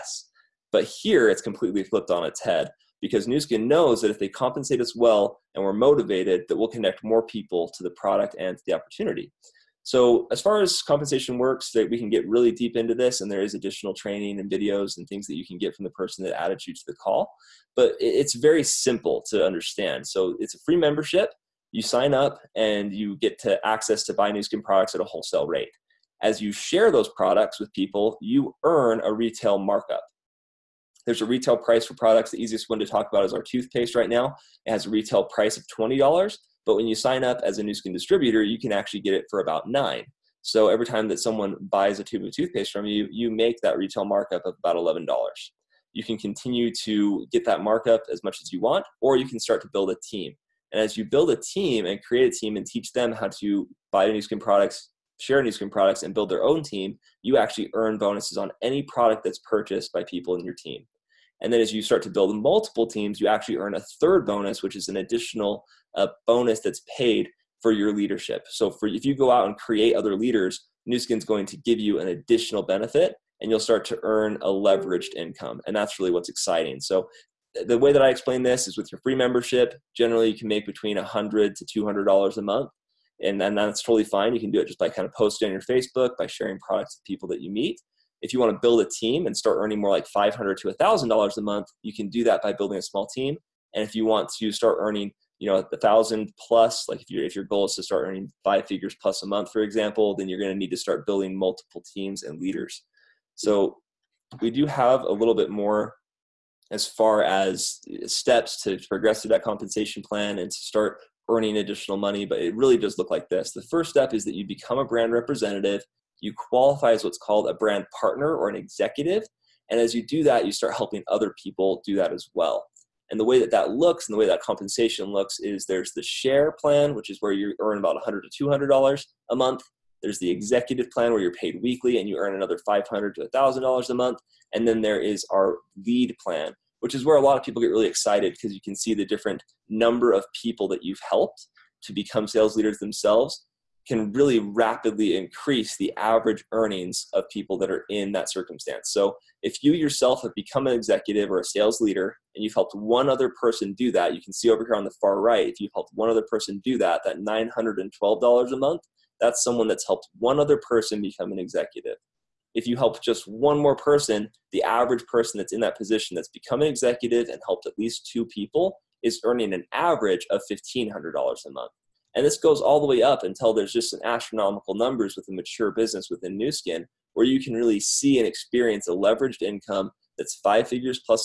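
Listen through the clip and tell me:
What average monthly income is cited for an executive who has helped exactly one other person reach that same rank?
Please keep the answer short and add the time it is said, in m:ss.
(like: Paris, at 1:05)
$912, at 2:37.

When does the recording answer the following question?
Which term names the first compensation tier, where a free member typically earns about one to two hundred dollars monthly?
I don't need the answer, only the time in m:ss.
2:06.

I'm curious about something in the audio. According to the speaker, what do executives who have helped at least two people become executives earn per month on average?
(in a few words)
$1,500.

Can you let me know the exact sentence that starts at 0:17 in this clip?
But it's very simple to understand.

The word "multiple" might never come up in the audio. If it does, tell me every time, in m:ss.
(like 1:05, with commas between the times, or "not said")
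1:02, 1:41.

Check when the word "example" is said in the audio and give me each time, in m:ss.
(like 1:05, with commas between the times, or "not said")
1:39.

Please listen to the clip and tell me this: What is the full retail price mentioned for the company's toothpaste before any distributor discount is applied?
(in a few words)
$20.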